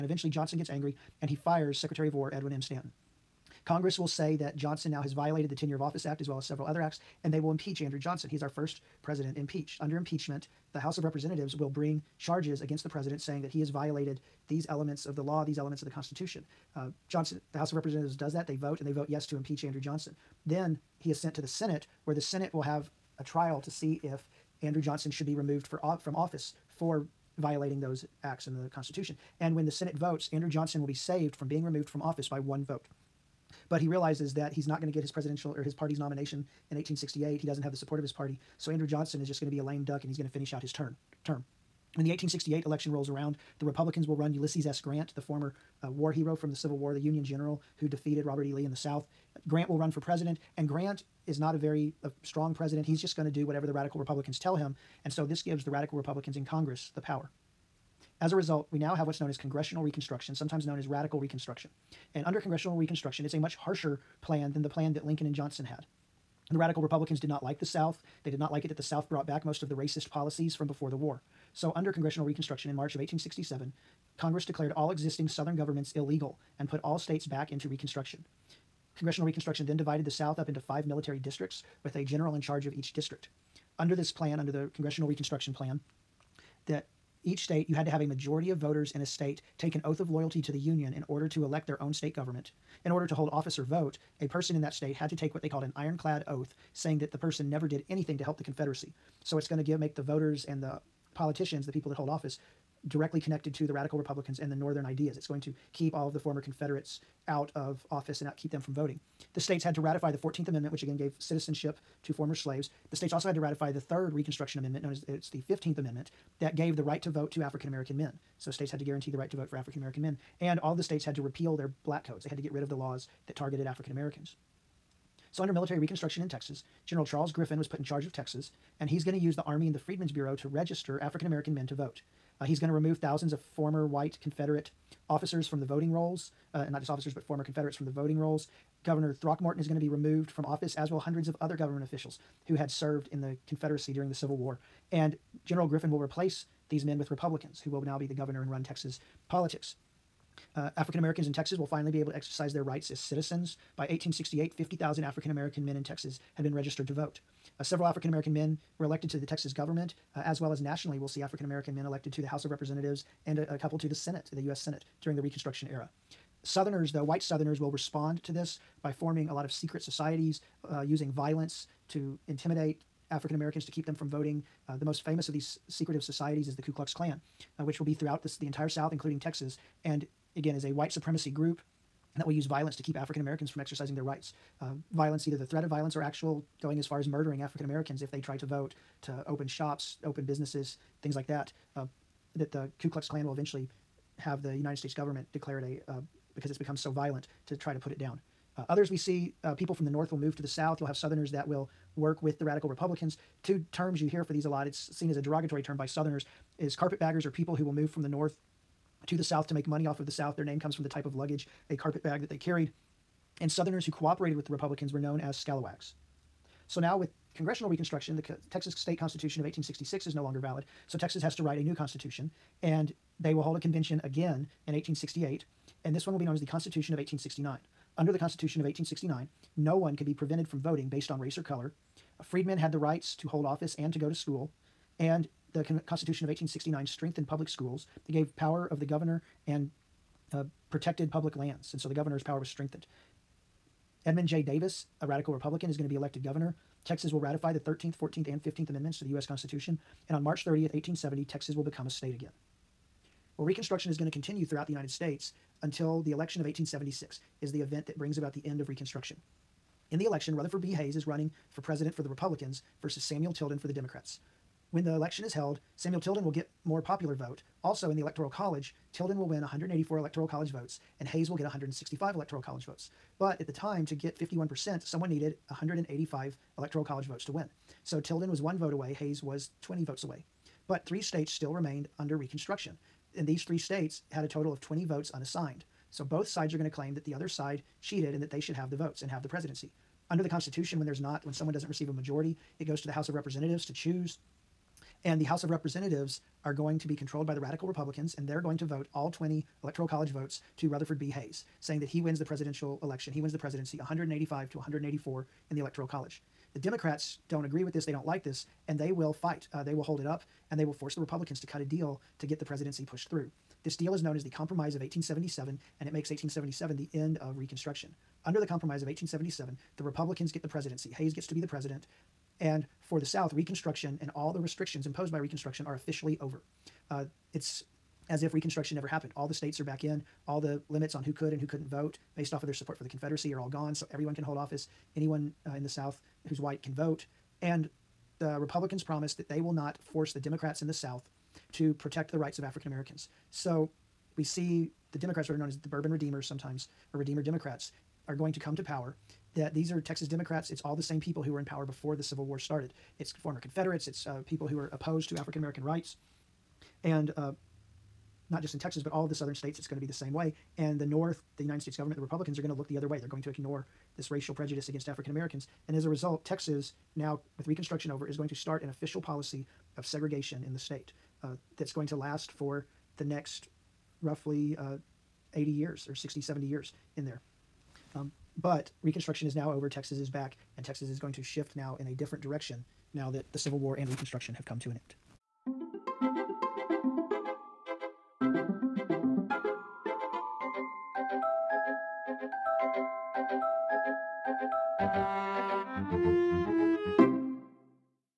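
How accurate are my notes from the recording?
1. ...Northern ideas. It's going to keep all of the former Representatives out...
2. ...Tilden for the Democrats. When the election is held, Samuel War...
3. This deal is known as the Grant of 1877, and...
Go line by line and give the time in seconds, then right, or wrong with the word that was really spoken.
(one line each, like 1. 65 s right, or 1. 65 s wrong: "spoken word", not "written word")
1. 104 s wrong: "Confederates", not "Representatives"
2. 263 s wrong: "Tilden", not "War"
3. 313 s wrong: "Compromise", not "Grant".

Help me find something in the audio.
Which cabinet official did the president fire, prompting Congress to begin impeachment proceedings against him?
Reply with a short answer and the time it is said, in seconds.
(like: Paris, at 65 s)
Edwin M. Stanton, at 2 s.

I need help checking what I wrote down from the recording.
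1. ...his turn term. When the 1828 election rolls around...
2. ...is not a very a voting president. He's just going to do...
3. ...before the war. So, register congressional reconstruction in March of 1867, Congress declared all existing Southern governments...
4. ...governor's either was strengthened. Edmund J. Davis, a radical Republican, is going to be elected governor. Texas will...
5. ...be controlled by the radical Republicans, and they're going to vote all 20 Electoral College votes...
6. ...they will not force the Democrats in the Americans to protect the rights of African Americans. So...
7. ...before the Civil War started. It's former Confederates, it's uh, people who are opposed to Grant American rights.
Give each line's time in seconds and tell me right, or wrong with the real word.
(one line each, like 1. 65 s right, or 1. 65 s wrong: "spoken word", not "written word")
1. 40 s wrong: "1868", not "1828"
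2. 51 s wrong: "strong", not "voting"
3. 70 s wrong: "under", not "register"
4. 241 s wrong: "power", not "either"
5. 296 s right
6. 339 s wrong: "South", not "Americans"
7. 351 s wrong: "African", not "Grant".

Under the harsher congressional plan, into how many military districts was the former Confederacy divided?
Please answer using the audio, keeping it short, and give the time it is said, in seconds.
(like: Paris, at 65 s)
5, at 80 s.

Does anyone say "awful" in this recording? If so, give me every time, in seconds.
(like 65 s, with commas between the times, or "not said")
not said.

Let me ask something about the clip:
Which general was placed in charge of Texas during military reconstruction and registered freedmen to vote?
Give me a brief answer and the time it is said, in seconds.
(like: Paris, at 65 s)
Charles Griffin, at 126 s.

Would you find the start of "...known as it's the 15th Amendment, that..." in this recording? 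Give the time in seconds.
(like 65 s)
114 s.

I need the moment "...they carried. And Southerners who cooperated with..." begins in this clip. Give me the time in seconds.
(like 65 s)
212 s.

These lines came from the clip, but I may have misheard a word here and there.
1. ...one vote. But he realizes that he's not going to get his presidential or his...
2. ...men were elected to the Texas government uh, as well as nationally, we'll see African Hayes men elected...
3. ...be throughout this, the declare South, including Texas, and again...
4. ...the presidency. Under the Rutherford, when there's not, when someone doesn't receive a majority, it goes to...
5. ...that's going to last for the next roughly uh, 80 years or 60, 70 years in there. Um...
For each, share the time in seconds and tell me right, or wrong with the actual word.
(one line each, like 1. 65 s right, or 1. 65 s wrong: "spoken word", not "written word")
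1. 32 s right
2. 158 s wrong: "American", not "Hayes"
3. 177 s wrong: "entire", not "declare"
4. 289 s wrong: "Constitution", not "Rutherford"
5. 371 s right.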